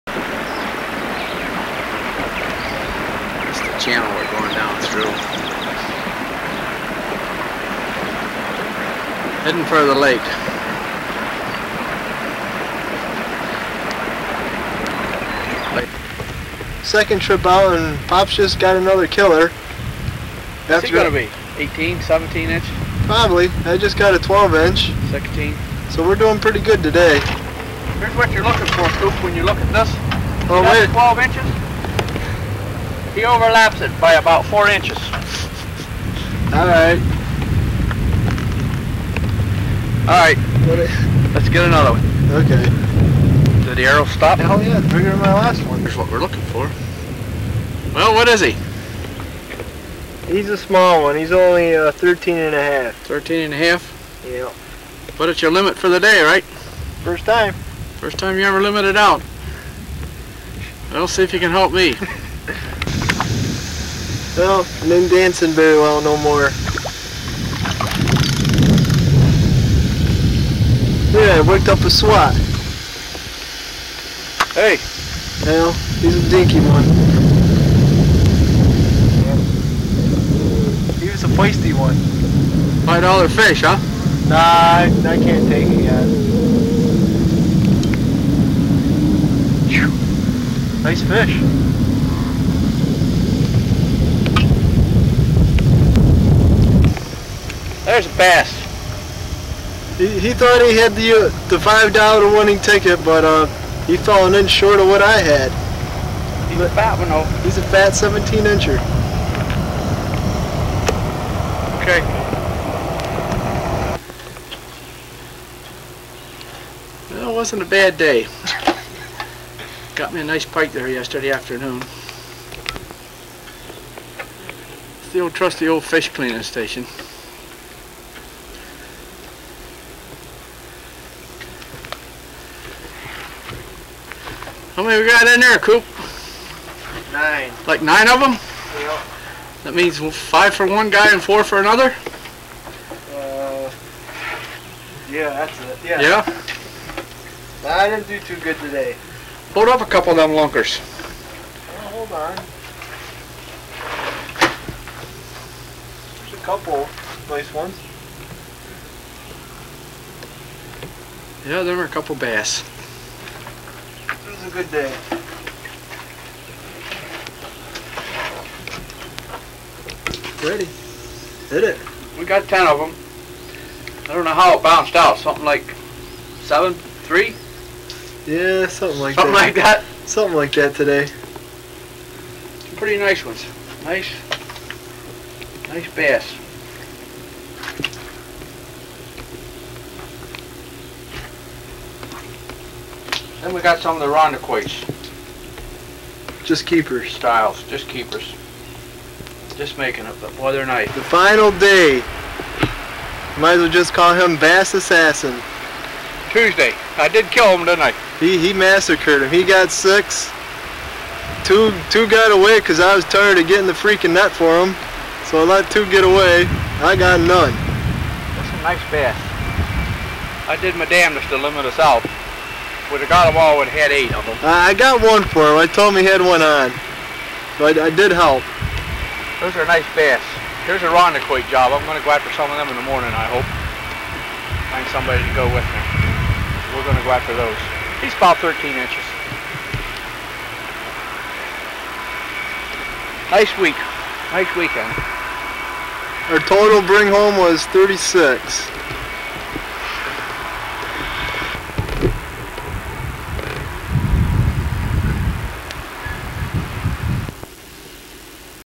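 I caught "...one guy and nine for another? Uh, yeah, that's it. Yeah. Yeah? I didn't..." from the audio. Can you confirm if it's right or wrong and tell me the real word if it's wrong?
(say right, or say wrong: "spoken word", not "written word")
wrong: "four", not "nine".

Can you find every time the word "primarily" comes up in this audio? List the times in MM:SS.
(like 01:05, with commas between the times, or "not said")
not said.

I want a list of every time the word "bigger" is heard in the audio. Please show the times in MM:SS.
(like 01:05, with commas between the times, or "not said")
00:44.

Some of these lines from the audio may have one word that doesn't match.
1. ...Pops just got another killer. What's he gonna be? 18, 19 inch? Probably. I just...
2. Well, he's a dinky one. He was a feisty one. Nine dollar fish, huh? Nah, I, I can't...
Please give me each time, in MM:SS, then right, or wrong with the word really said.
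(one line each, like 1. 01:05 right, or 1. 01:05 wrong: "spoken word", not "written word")
1. 00:18 wrong: "17", not "19"
2. 01:15 wrong: "Five", not "Nine".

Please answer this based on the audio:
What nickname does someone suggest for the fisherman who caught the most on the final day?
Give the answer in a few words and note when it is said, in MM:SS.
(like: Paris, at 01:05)
Bass Assassin, at 03:24.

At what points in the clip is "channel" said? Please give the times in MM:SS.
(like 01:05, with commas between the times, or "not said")
00:03.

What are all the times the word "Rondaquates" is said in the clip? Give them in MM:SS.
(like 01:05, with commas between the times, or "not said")
03:14, 03:50.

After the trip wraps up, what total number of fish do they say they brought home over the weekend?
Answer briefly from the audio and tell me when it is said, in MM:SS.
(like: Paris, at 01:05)
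36, at 04:07.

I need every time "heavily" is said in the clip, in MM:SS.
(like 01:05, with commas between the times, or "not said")
not said.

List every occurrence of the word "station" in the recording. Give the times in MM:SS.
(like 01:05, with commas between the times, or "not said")
02:06.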